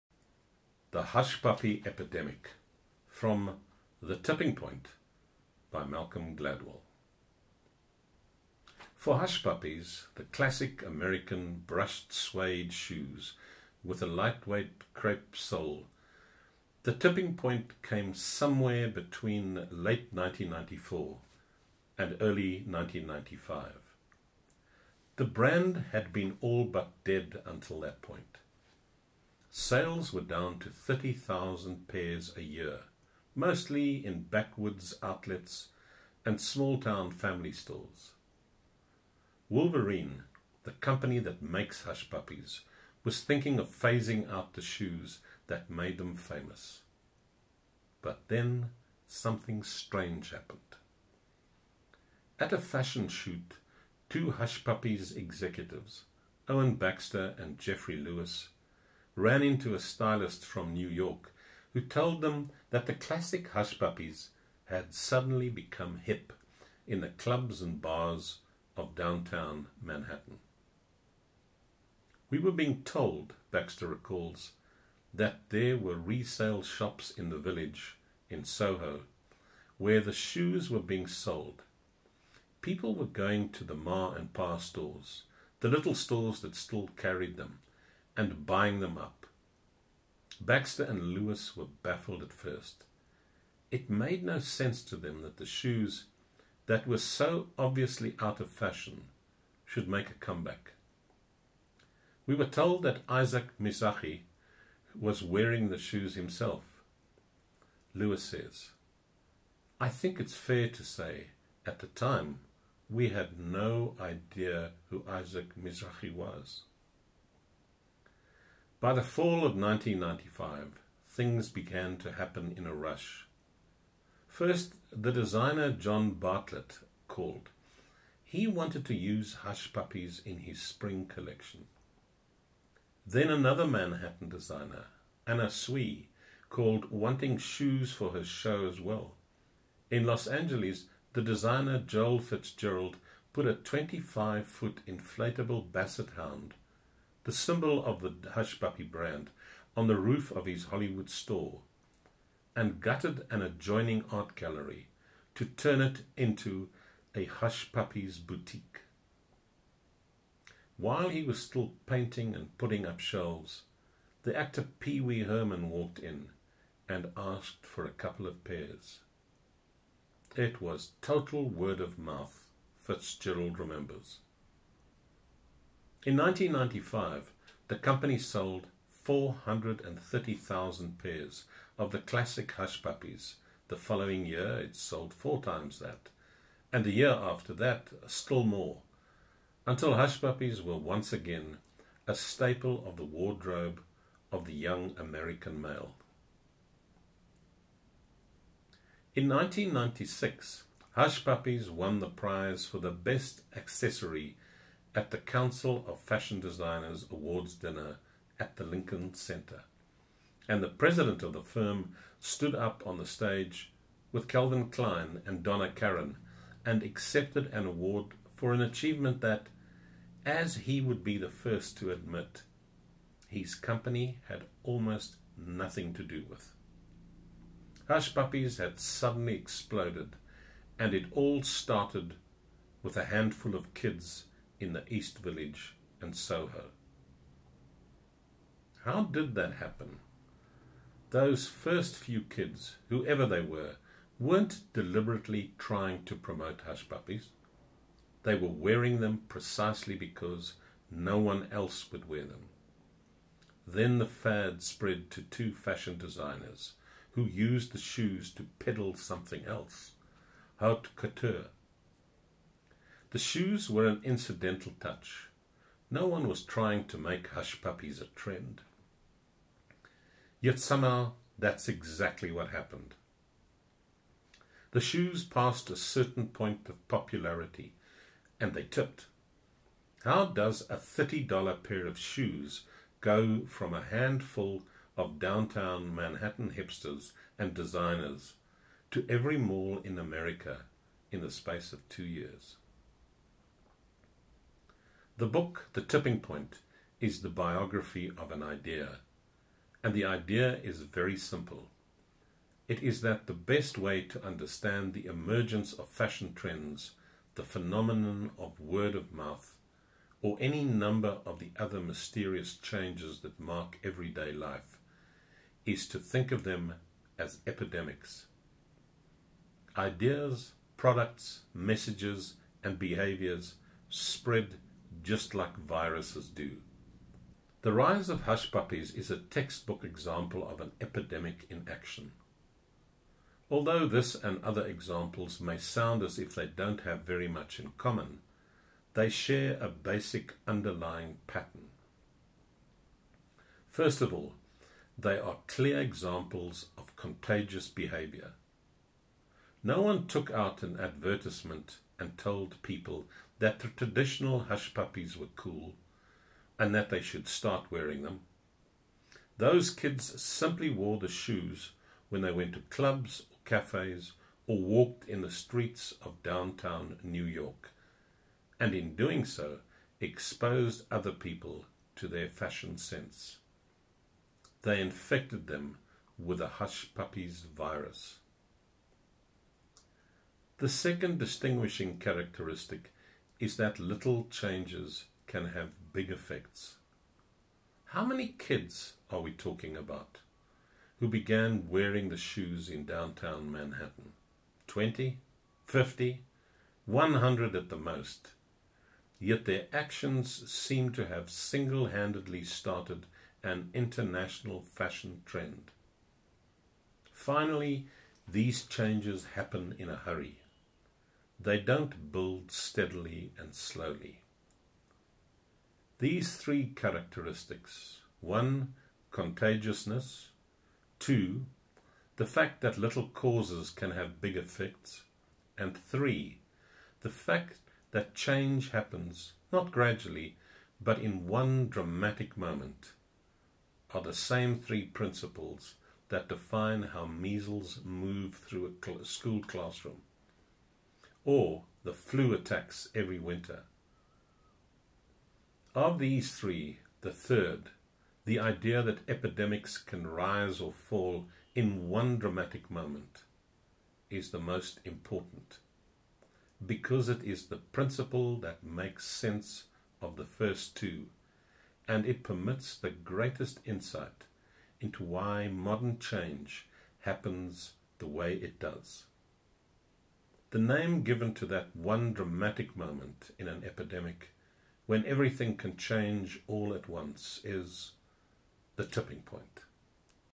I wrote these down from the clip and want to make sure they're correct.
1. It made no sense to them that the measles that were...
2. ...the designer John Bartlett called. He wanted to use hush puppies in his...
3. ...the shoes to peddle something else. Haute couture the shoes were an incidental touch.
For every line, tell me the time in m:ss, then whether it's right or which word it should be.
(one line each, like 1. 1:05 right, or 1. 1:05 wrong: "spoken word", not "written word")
1. 1:33 wrong: "shoes", not "measles"
2. 2:04 right
3. 4:17 right.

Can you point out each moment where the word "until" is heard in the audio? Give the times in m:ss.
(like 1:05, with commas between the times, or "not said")
0:27, 3:09.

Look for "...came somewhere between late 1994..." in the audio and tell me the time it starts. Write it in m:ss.
0:17.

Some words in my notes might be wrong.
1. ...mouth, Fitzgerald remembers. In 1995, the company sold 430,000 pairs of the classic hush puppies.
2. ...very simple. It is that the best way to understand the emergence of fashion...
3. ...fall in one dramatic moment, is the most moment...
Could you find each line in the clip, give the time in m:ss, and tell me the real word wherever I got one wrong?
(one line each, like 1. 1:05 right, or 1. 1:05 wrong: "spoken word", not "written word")
1. 2:51 right
2. 5:00 right
3. 7:30 wrong: "important", not "moment".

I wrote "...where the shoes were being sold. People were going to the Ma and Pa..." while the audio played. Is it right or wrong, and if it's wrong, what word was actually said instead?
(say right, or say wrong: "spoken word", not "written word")
right.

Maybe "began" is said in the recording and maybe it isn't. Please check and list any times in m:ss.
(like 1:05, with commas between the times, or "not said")
2:01, 6:31.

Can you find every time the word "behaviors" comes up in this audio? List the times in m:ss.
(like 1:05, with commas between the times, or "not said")
5:22, 5:47.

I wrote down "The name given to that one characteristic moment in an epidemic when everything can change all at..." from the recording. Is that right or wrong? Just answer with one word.
wrong.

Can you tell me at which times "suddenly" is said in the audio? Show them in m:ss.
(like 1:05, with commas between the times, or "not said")
1:04, 3:48.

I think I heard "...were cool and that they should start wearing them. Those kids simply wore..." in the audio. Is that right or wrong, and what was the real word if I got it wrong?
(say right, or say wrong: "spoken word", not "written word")
right.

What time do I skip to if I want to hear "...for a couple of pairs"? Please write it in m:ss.
2:47.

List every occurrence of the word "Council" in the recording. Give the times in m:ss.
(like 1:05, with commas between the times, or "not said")
3:25.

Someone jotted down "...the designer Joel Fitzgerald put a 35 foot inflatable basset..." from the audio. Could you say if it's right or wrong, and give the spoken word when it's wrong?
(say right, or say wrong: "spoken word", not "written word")
wrong: "25", not "35".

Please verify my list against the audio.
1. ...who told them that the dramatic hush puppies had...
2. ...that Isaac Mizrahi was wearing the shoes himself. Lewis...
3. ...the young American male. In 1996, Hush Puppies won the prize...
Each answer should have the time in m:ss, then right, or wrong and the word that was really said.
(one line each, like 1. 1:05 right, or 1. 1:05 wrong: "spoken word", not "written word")
1. 1:01 wrong: "classic", not "dramatic"
2. 1:42 right
3. 3:14 right.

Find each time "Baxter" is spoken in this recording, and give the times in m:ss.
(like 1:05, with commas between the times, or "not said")
0:56, 1:13, 1:30.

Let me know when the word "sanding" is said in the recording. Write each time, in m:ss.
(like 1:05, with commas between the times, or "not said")
not said.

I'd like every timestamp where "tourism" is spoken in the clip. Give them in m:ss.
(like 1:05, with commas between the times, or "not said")
not said.